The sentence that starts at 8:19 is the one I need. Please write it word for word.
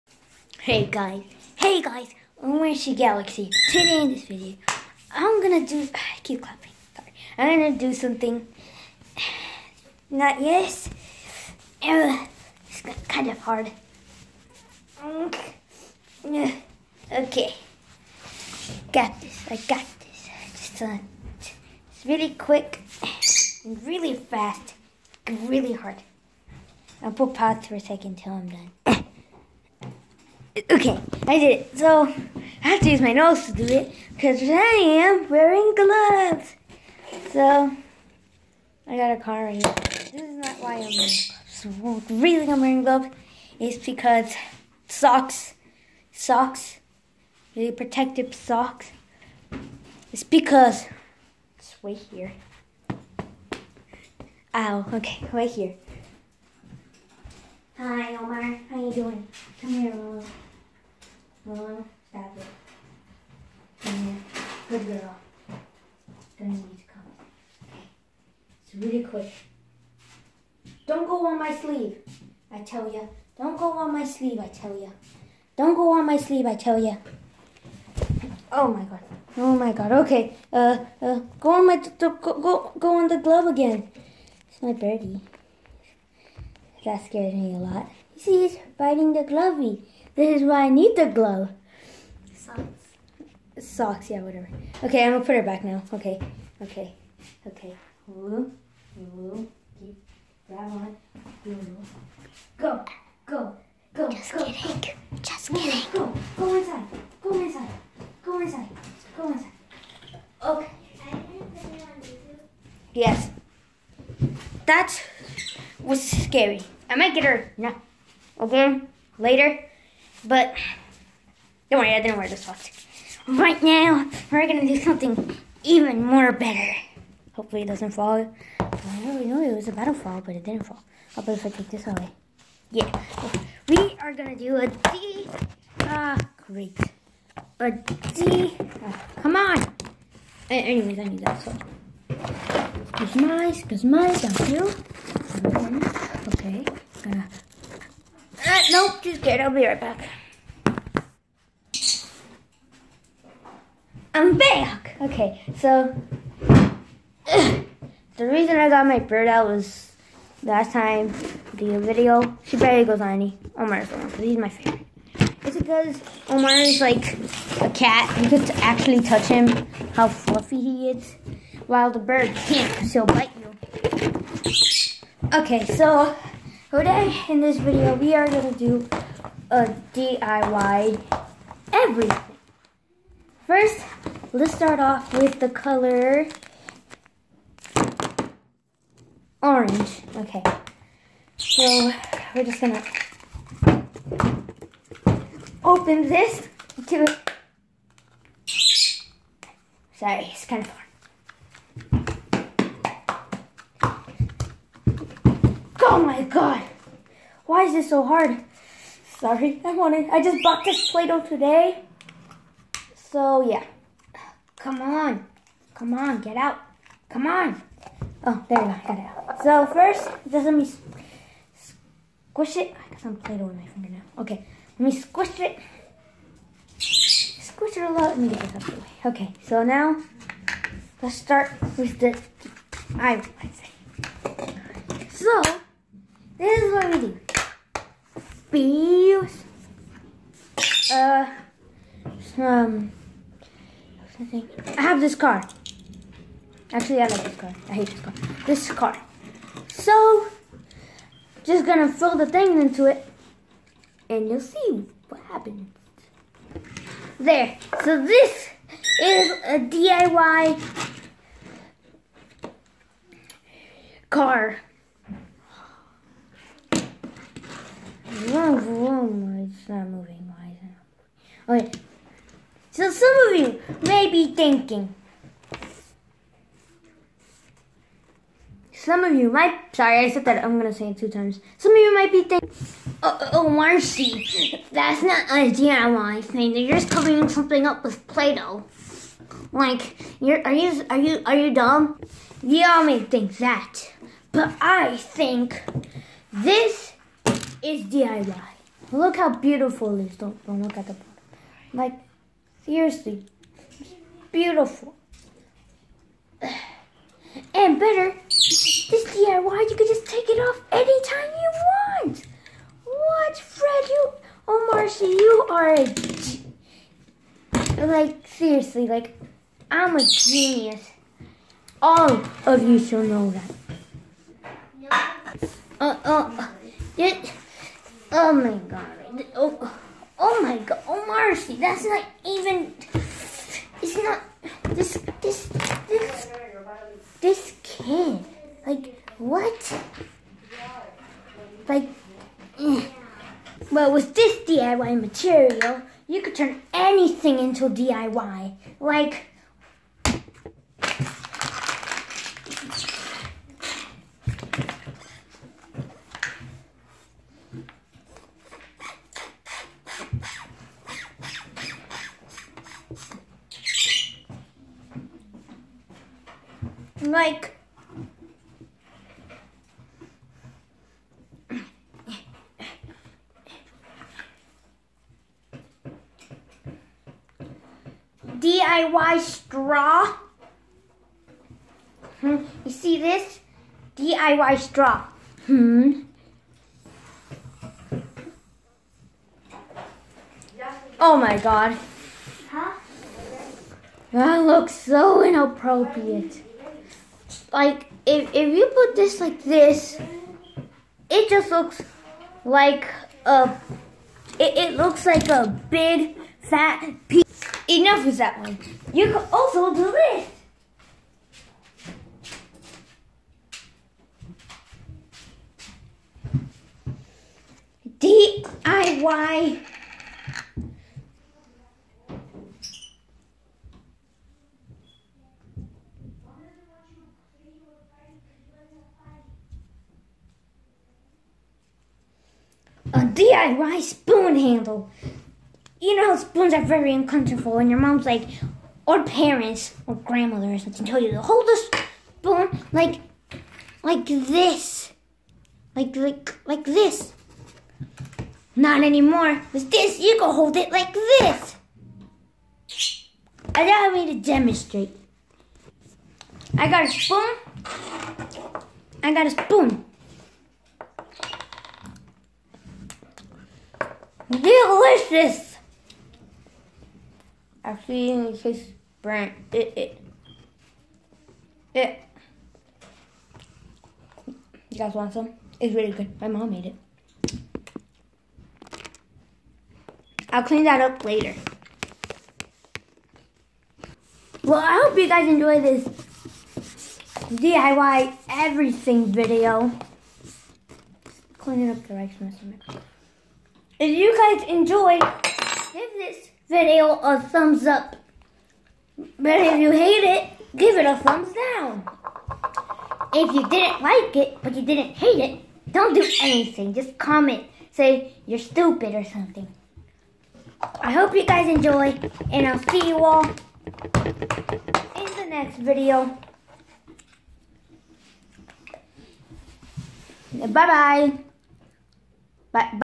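But if you hate it, give it a thumbs down.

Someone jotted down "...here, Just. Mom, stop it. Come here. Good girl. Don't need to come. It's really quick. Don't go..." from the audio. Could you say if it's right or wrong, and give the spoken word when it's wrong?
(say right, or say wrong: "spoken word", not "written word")
wrong: "Omar", not "Just".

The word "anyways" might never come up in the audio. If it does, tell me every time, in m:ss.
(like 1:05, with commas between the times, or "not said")
2:20.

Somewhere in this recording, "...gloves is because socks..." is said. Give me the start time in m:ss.
0:42.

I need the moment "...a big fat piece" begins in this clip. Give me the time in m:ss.
6:45.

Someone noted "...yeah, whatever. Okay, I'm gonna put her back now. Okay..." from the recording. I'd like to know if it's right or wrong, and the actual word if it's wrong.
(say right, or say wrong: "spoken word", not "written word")
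right.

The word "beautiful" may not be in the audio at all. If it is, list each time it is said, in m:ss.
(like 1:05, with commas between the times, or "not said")
4:59, 5:04.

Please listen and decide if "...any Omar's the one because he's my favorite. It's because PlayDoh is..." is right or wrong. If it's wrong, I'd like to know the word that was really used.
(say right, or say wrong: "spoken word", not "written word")
wrong: "Omar", not "PlayDoh".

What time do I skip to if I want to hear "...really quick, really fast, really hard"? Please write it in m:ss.
0:22.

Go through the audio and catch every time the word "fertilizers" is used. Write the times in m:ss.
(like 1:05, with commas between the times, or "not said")
not said.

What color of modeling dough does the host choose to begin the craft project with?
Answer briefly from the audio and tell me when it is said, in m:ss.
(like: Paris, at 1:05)
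orange, at 3:05.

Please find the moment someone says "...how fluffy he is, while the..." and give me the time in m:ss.
2:49.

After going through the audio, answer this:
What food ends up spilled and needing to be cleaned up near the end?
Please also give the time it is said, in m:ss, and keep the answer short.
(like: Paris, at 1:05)
rice, at 8:11.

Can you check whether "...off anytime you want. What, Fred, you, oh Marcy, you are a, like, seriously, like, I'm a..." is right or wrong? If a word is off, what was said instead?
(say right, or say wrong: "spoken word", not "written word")
right.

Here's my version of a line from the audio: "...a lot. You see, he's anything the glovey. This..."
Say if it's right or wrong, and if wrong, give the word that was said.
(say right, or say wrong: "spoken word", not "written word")
wrong: "biting", not "anything".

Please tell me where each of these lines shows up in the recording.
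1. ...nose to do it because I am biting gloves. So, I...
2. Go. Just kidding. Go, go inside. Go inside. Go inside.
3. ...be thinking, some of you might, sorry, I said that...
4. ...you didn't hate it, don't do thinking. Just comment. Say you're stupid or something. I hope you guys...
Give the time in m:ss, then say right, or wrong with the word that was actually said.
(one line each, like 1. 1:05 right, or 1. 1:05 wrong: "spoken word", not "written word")
1. 0:33 wrong: "wearing", not "biting"
2. 1:44 right
3. 4:34 right
4. 8:24 wrong: "anything", not "thinking".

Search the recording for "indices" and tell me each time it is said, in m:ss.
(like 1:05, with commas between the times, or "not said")
not said.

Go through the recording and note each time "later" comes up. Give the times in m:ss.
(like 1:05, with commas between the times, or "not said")
1:59, 8:01.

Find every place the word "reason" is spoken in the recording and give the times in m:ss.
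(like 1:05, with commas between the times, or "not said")
0:42, 2:38.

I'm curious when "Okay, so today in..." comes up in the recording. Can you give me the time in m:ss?
2:55.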